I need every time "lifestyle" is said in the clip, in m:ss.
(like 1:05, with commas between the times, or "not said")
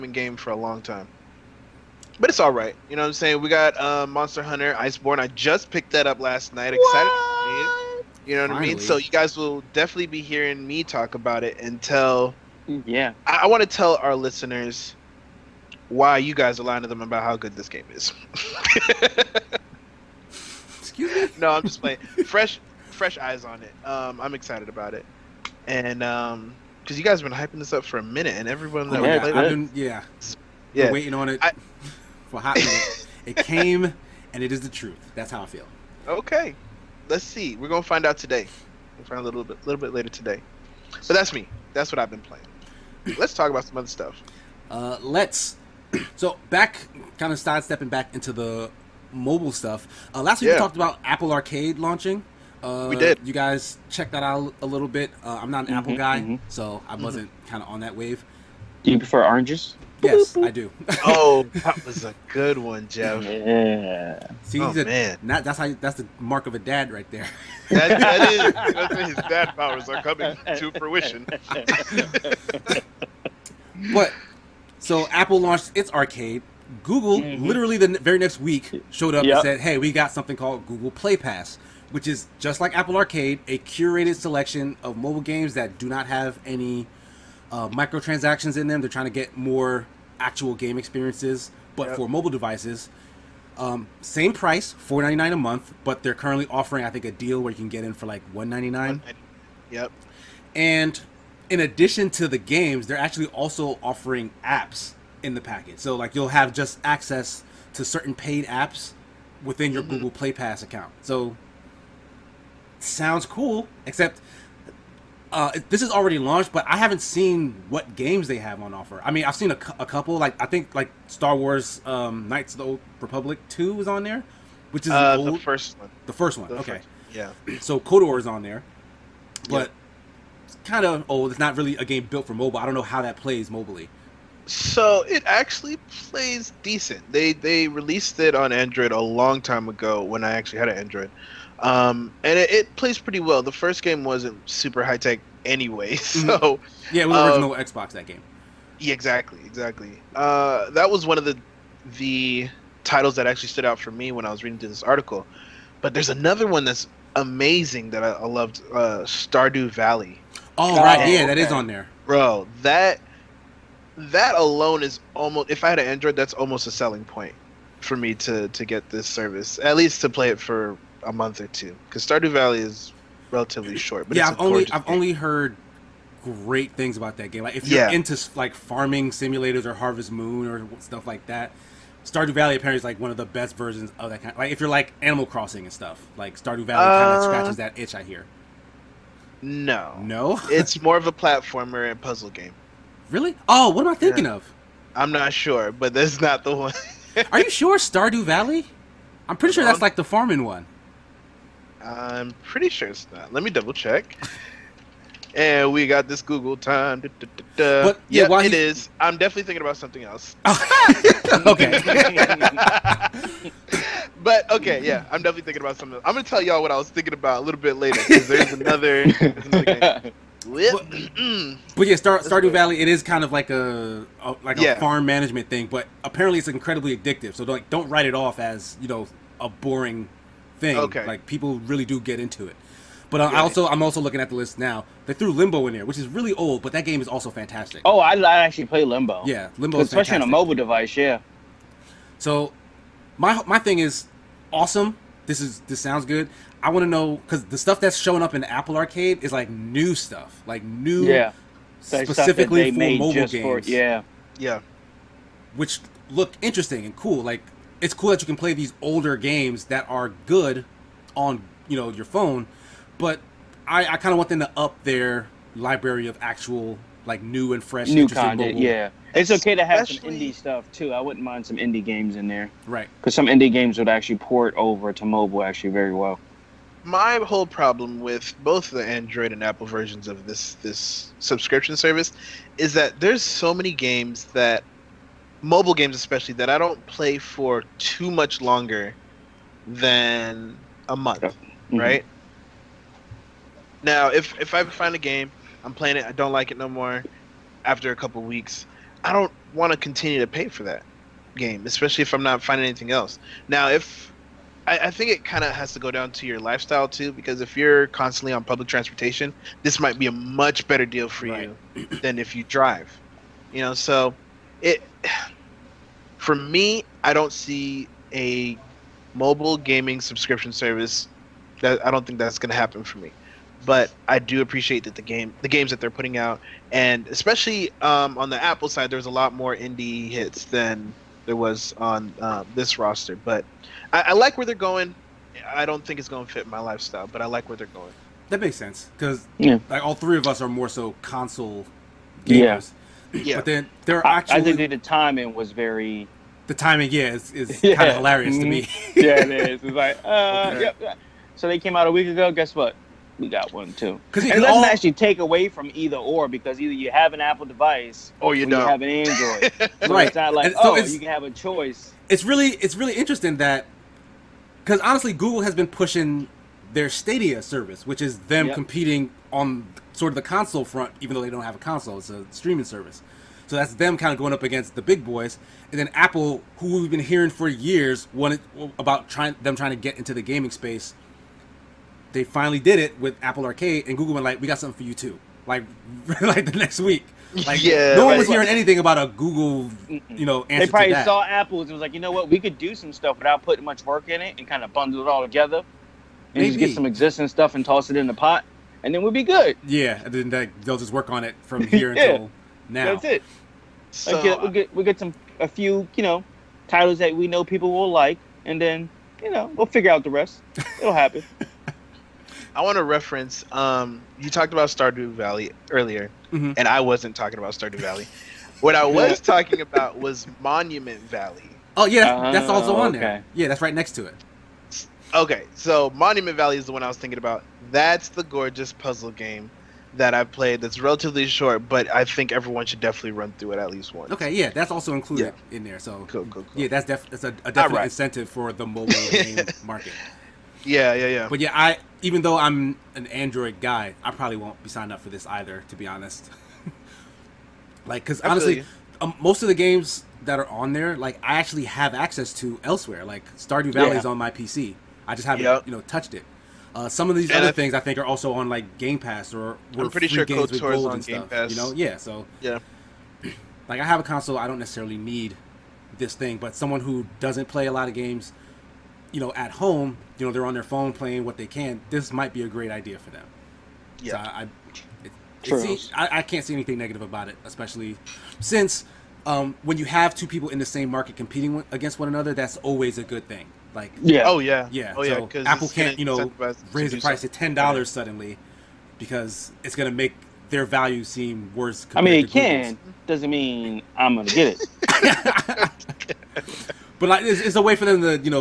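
5:06, 5:36.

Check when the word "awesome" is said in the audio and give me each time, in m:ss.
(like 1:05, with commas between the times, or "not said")
4:04.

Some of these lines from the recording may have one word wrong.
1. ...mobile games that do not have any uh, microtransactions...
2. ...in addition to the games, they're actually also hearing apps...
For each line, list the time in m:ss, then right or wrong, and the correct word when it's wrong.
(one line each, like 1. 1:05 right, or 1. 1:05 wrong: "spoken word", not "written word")
1. 1:24 right
2. 1:41 wrong: "offering", not "hearing".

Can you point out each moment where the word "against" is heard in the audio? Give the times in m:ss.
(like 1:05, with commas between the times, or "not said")
6:14, 8:01.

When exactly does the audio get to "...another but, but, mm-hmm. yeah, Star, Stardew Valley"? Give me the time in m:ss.
3:39.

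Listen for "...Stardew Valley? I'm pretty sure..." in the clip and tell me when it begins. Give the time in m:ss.
3:17.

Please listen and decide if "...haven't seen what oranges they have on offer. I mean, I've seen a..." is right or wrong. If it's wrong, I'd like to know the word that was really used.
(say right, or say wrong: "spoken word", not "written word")
wrong: "games", not "oranges".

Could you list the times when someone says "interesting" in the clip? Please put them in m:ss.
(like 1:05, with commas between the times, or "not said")
4:16, 6:02.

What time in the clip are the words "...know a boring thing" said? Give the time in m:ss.
3:48.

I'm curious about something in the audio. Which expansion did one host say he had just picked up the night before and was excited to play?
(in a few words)
Monster Hunter Iceborne.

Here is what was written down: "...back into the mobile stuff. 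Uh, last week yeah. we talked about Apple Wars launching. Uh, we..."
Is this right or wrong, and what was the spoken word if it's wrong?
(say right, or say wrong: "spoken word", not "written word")
wrong: "Arcade", not "Wars".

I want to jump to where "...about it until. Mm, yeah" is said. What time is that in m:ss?
0:11.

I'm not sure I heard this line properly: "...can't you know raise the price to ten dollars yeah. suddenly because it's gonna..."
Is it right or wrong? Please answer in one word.
right.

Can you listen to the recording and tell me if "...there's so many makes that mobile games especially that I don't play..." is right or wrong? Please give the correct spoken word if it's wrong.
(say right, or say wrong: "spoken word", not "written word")
wrong: "games", not "makes".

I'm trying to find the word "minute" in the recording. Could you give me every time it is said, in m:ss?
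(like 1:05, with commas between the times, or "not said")
0:28, 0:32.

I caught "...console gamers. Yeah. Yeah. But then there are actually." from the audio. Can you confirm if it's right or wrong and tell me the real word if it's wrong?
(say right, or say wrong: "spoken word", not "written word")
right.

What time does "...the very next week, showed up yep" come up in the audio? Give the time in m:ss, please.
1:17.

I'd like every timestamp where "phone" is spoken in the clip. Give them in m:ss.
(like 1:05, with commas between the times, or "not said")
4:22, 7:50.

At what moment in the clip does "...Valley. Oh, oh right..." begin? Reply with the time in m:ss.
2:39.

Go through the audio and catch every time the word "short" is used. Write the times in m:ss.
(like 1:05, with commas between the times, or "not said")
2:53, 7:11.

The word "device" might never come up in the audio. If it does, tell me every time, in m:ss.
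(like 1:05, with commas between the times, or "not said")
1:32, 4:00, 5:57.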